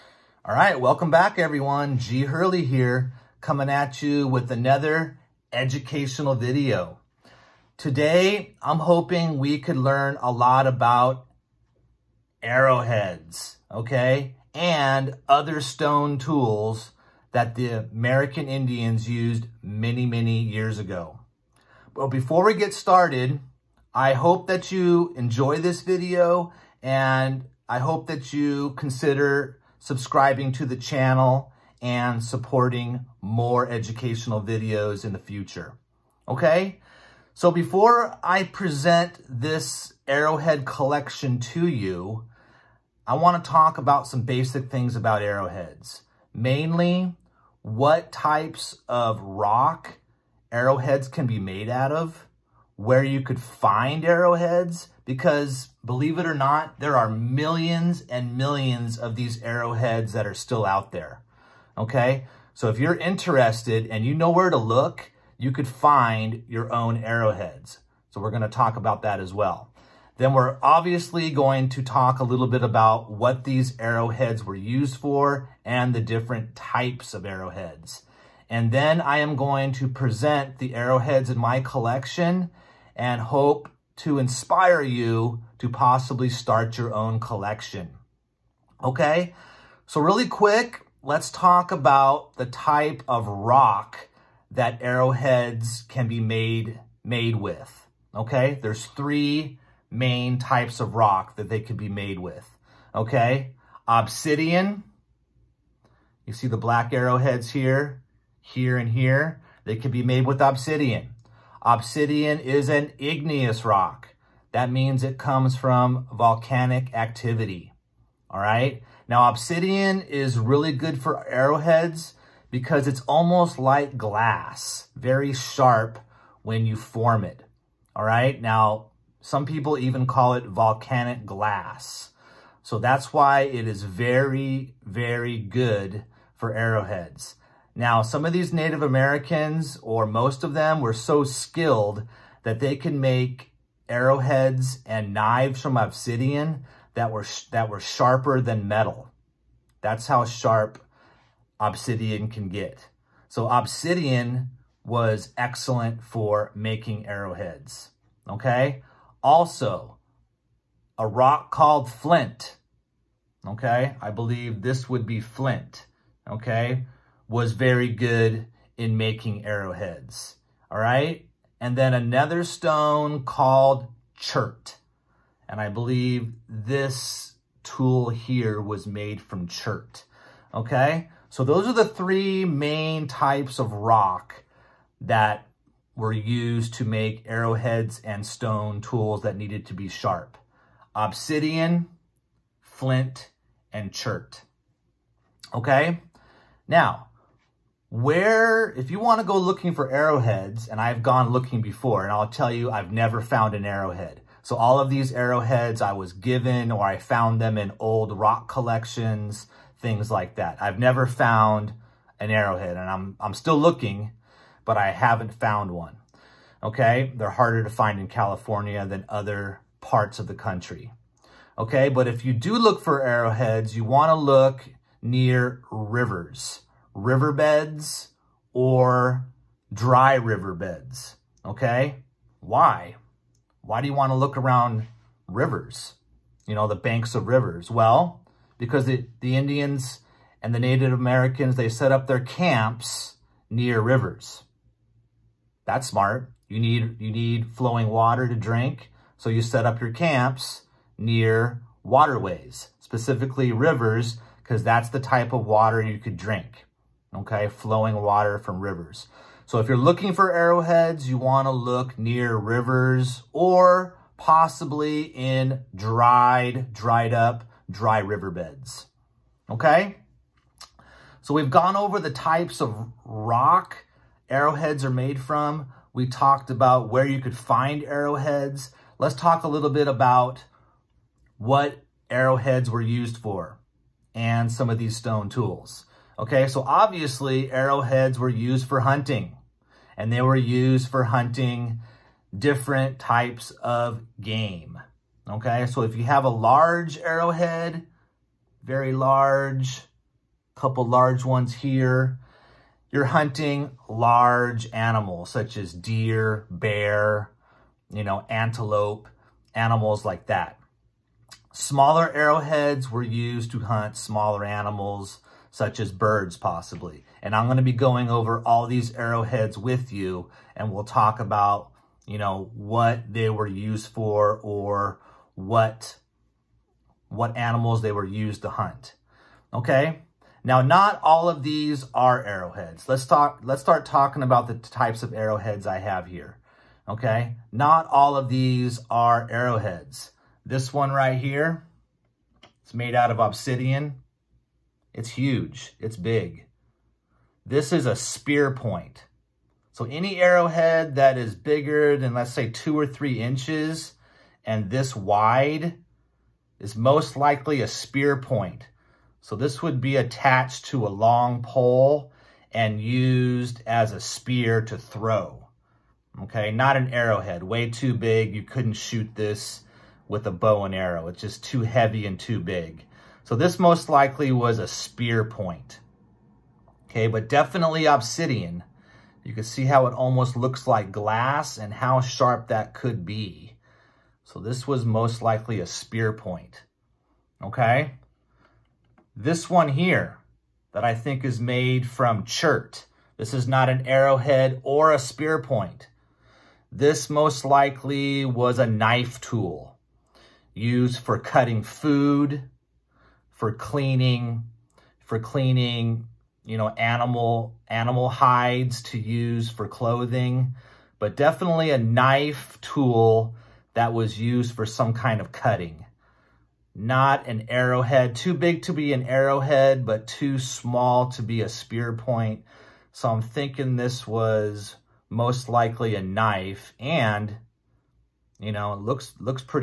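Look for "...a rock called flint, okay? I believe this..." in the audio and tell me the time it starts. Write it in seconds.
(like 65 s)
160 s.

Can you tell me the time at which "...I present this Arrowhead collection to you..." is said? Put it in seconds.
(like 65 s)
38 s.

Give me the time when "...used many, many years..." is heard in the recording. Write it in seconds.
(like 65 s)
19 s.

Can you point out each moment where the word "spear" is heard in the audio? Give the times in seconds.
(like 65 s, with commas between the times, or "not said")
347 s, 357 s, 364 s, 374 s, 385 s, 394 s, 421 s.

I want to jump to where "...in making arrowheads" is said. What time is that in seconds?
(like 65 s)
168 s.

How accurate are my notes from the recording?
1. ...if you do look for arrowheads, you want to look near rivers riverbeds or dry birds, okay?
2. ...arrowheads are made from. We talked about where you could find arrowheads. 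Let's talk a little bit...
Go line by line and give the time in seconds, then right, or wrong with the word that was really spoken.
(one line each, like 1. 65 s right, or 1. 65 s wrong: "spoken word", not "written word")
1. 222 s wrong: "riverbeds", not "birds"
2. 274 s right.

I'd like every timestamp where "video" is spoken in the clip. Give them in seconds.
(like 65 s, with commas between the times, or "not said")
6 s, 25 s, 34 s.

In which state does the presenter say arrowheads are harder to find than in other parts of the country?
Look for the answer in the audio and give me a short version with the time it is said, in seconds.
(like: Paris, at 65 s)
California, at 218 s.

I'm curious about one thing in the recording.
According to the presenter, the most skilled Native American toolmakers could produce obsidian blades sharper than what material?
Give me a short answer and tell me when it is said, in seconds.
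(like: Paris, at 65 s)
Metal, at 148 s.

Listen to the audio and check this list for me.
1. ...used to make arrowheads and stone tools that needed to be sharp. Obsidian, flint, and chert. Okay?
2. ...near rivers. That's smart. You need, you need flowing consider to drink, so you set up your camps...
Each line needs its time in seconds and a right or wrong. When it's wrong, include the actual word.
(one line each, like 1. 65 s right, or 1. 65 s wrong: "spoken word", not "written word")
1. 186 s right
2. 243 s wrong: "water", not "consider".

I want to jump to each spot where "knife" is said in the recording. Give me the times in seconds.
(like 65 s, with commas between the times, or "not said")
398 s, 411 s, 426 s.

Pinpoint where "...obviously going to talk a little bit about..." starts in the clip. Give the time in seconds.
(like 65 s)
70 s.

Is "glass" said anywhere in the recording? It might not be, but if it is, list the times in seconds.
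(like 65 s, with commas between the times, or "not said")
123 s, 131 s, 380 s.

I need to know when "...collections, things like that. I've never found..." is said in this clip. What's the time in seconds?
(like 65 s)
208 s.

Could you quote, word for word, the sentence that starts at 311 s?
Smaller arrowheads were used to hunt smaller animals such as birds possibly.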